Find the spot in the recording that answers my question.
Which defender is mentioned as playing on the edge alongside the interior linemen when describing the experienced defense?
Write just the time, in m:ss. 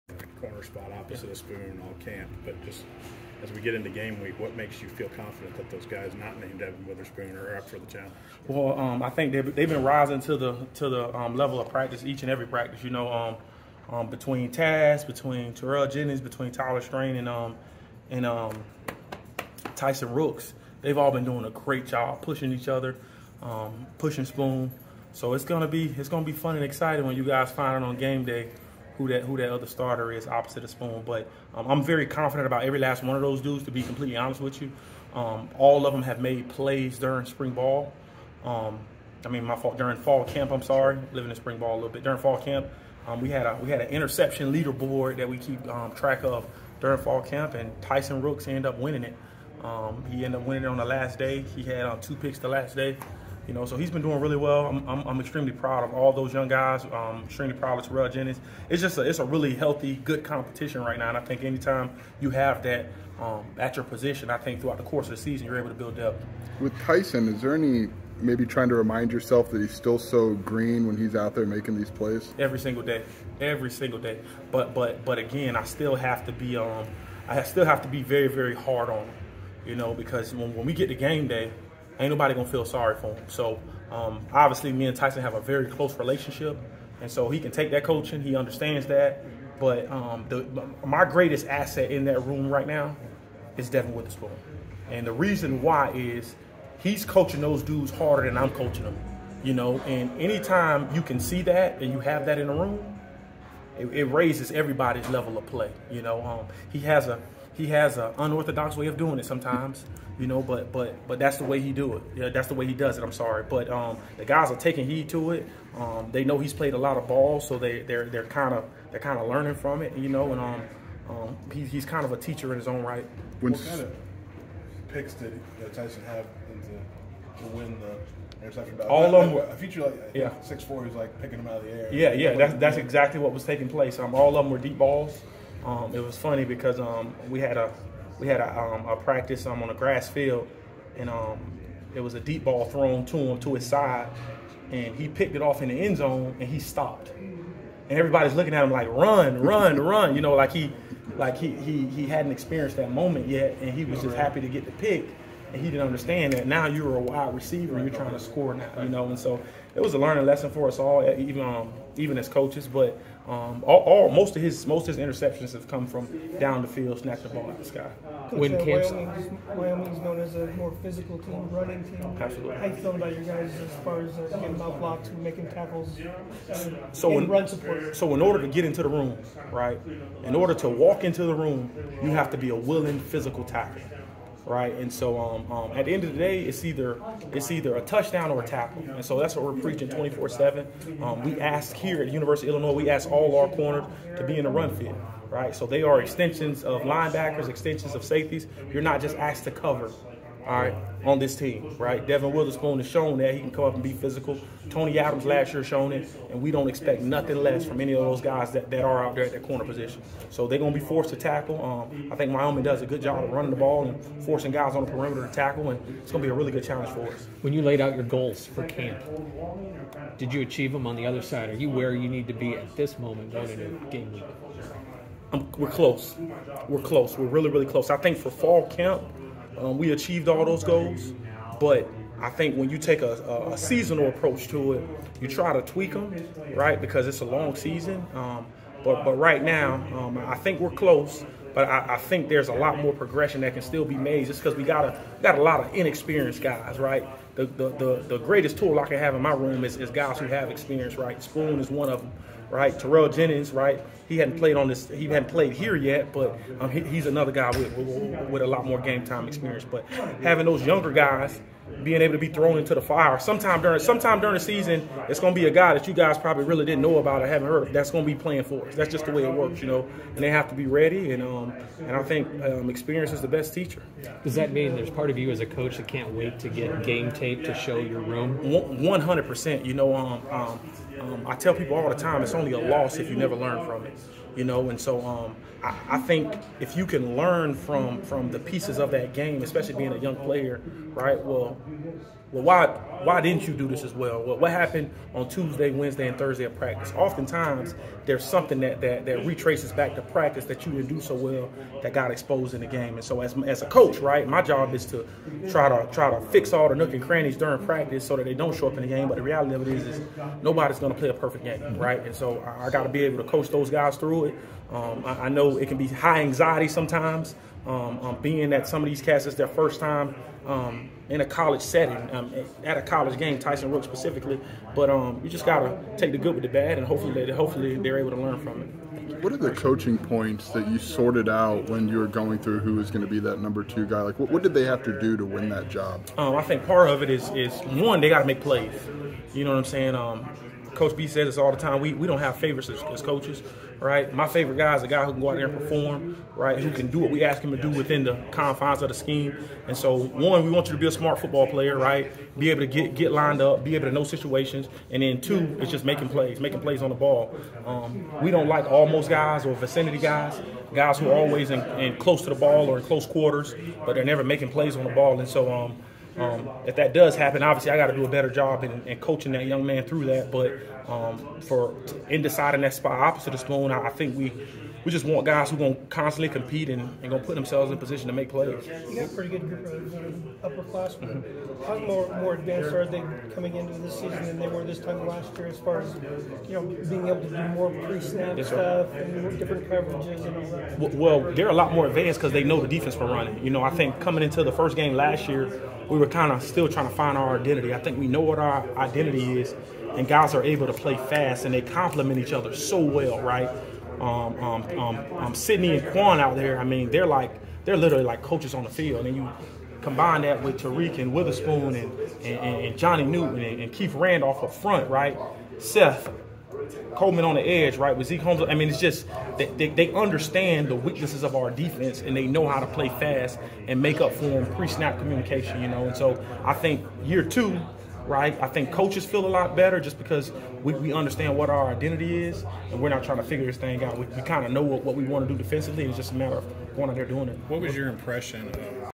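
6:55.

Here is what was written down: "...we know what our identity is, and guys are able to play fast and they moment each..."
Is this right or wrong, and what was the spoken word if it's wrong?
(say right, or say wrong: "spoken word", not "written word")
wrong: "complement", not "moment".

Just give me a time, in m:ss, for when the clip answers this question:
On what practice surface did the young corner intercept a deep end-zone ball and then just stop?
2:19.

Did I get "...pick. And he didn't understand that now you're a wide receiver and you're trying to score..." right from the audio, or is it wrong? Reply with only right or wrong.
right.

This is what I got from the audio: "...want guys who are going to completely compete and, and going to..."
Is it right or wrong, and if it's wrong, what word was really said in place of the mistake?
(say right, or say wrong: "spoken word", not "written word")
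wrong: "constantly", not "completely".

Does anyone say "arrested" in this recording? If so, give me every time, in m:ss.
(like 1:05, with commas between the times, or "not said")
not said.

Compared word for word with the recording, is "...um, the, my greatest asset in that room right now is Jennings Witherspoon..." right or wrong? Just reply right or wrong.
wrong.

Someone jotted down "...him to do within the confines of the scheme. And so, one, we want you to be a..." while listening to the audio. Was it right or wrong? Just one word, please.
right.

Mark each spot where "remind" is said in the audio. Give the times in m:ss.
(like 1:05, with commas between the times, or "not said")
1:08.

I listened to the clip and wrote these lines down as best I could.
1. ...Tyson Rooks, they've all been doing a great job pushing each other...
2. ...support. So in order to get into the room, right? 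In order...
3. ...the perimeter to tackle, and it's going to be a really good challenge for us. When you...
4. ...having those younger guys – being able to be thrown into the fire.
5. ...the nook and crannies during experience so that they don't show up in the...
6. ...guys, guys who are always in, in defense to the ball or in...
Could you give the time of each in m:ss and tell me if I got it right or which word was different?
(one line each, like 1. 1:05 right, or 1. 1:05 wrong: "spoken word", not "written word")
1. 0:19 right
2. 2:57 right
3. 3:34 right
4. 4:20 right
5. 5:06 wrong: "practice", not "experience"
6. 5:59 wrong: "close", not "defense".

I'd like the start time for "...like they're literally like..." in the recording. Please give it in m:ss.
6:47.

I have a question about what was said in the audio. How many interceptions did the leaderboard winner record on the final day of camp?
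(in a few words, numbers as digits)
2.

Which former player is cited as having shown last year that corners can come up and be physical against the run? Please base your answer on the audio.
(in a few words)
Tony Adams.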